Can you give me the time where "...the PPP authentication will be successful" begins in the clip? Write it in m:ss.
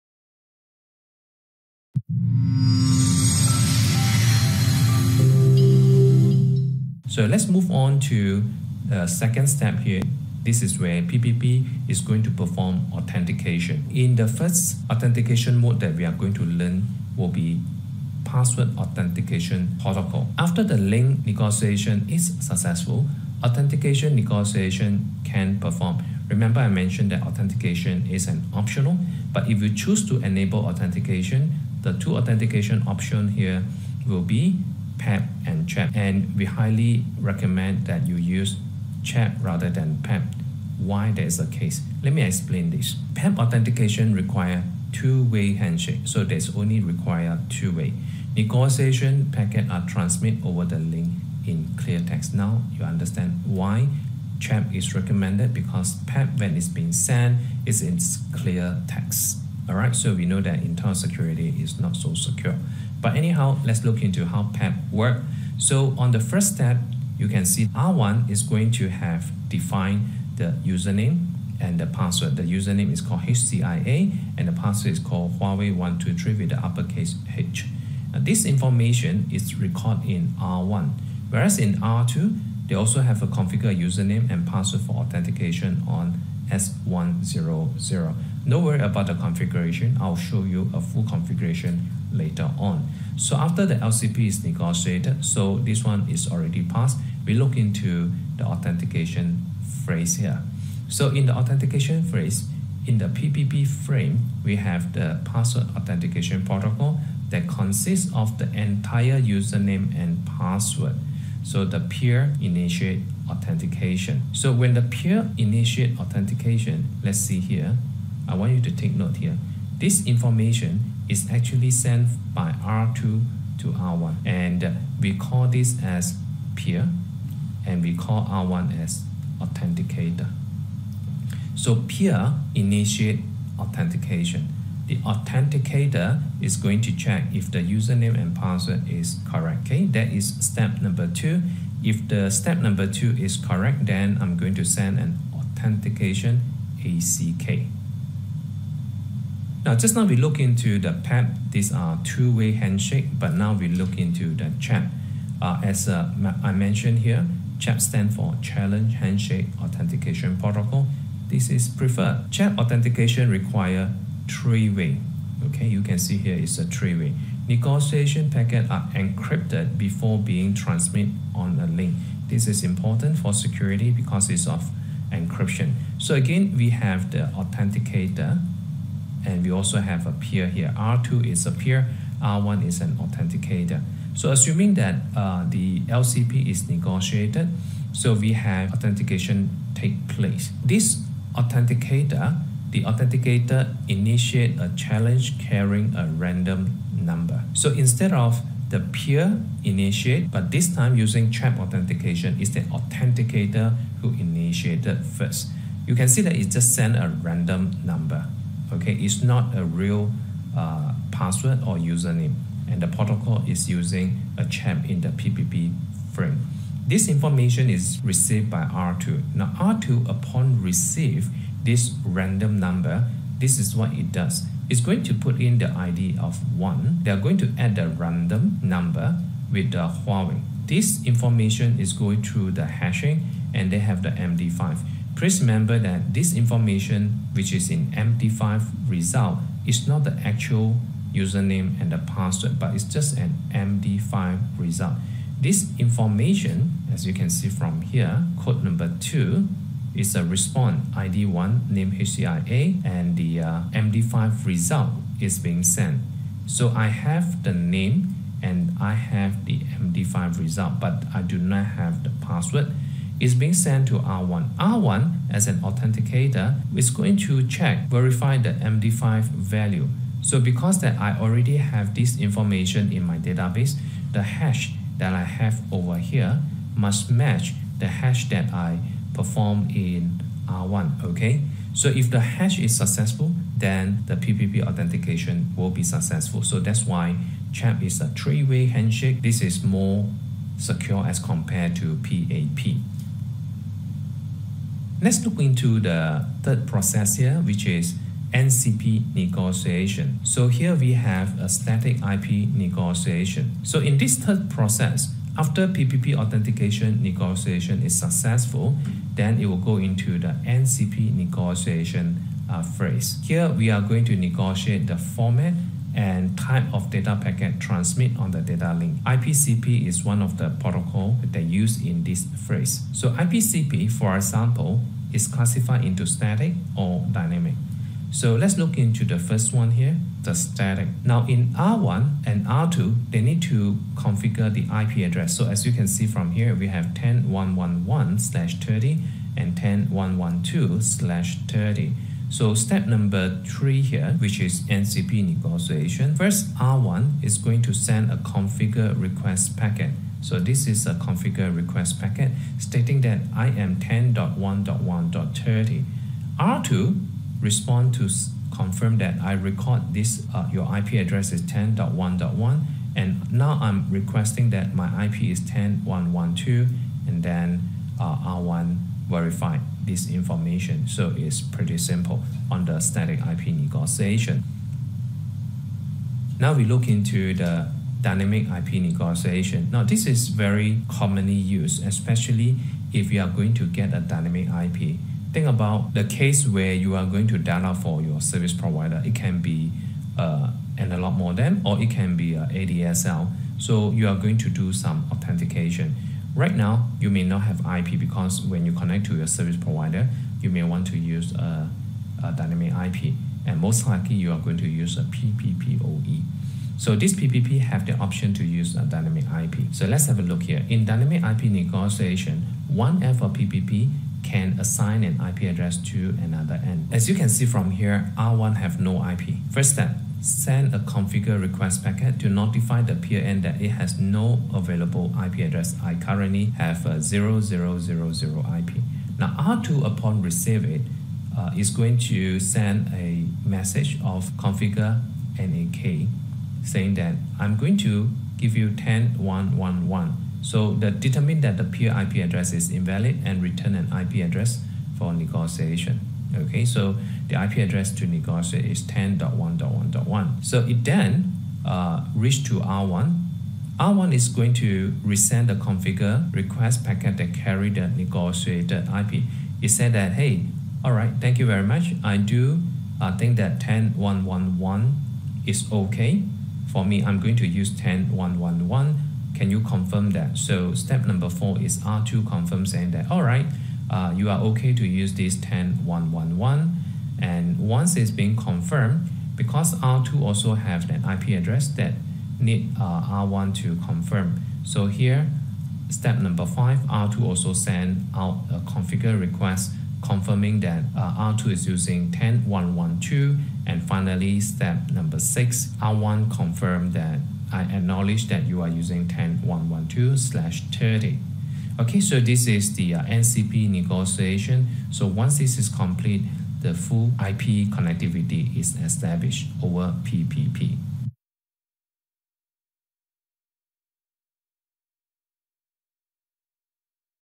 4:44.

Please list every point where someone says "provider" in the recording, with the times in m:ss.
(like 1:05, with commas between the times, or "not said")
6:28, 6:39.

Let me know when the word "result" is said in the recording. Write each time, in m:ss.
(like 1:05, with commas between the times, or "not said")
3:58, 4:04, 4:14, 4:20.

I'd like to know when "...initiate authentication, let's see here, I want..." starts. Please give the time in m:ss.
1:55.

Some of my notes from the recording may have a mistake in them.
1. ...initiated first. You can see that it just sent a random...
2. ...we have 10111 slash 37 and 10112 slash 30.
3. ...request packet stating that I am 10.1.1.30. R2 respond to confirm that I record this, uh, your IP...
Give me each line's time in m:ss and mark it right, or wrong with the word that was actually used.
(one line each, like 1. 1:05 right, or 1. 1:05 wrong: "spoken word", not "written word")
1. 3:24 right
2. 5:36 wrong: "30", not "37"
3. 5:51 right.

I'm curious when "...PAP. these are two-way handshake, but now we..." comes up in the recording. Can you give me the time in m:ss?
2:31.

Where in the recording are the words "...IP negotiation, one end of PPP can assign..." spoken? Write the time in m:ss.
6:51.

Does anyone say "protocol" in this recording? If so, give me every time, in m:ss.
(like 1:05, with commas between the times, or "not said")
0:19, 1:46, 2:40, 3:32, 5:20.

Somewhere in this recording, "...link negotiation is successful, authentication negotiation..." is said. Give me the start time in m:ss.
0:20.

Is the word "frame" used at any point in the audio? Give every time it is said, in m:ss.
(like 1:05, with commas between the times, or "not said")
1:43, 3:36.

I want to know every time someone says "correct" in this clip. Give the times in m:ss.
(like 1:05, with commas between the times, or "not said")
2:19, 2:23.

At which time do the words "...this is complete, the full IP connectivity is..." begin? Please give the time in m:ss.
8:25.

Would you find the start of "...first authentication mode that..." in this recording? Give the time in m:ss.
0:14.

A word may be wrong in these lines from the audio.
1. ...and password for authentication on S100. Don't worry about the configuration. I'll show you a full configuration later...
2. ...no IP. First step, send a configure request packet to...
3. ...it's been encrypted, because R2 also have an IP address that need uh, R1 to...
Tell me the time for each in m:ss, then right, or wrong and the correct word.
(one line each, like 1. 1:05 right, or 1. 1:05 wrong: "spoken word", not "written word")
1. 1:24 right
2. 6:58 right
3. 7:57 wrong: "confirmed", not "encrypted".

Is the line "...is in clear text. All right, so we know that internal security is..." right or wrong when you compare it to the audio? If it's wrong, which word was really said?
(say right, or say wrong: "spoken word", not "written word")
right.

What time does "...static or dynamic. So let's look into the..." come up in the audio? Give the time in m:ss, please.
5:26.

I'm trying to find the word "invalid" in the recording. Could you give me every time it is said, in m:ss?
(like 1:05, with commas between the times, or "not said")
7:22.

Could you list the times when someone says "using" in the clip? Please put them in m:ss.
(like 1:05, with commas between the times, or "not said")
3:20, 3:33, 8:11, 8:18.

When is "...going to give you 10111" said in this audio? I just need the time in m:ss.
7:17.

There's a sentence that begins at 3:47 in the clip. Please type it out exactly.
They are going to add the random number with the Huawei.